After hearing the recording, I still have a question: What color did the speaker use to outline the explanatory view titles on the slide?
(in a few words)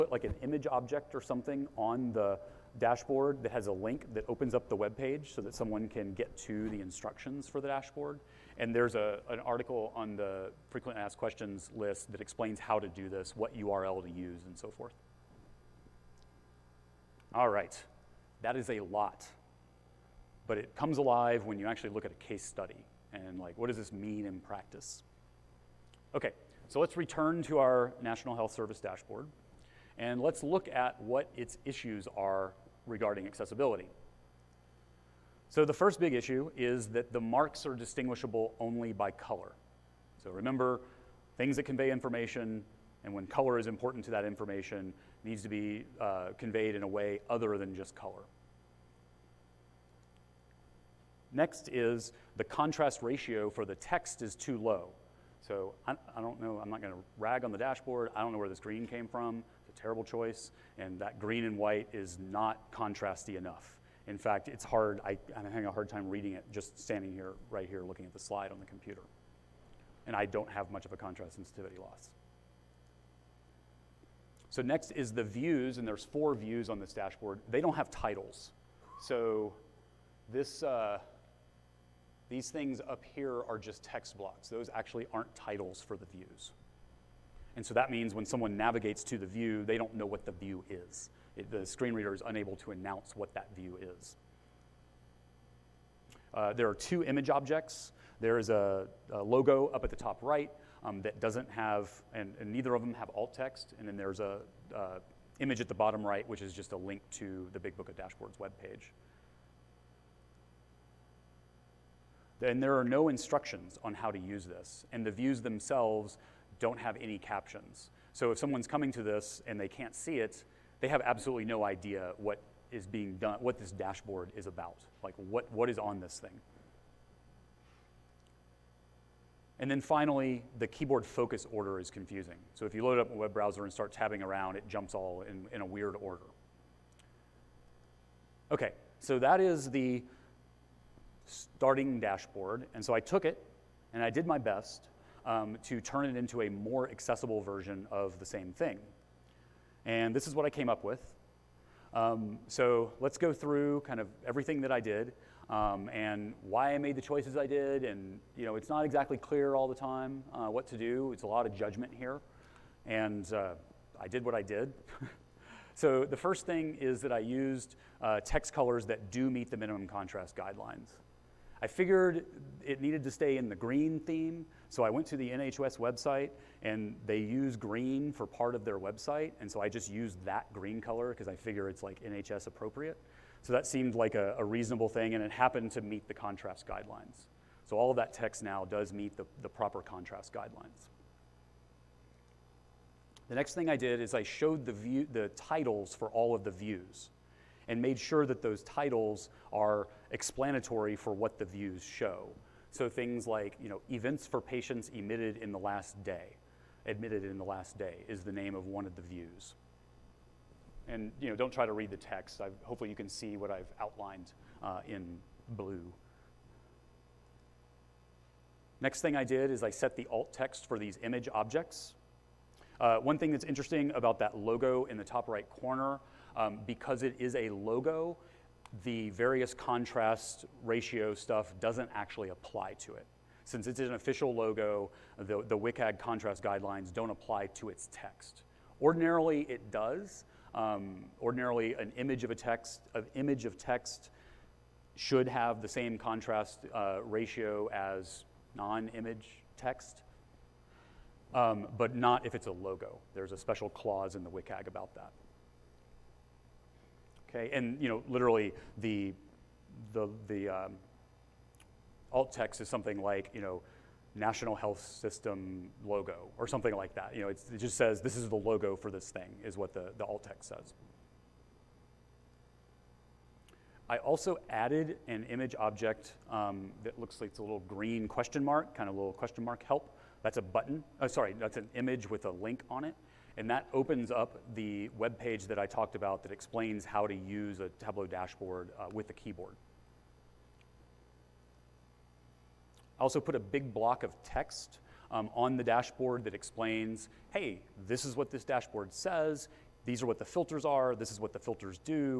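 Blue.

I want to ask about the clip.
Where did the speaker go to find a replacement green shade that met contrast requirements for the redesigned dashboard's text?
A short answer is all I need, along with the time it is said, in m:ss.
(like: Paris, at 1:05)
NHS website, at 2:55.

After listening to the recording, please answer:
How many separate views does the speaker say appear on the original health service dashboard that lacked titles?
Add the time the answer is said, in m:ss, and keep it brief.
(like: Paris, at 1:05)
4, at 1:16.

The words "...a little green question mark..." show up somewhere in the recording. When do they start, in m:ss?
4:37.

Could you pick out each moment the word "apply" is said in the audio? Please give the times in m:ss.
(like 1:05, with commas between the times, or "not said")
3:52, 3:57.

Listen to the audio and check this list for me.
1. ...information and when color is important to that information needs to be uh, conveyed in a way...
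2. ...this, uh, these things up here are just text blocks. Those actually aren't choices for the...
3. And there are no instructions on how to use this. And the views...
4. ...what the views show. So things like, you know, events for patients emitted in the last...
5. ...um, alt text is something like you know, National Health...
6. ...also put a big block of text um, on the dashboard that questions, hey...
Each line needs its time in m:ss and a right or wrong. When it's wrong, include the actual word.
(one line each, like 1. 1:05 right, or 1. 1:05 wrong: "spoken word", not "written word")
1. 0:41 right
2. 1:20 wrong: "titles", not "choices"
3. 1:52 right
4. 3:21 right
5. 4:20 right
6. 4:53 wrong: "explains", not "questions".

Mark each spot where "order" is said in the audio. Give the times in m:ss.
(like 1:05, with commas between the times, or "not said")
2:11, 2:16.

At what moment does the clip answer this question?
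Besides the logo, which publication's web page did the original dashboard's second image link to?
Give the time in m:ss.
1:47.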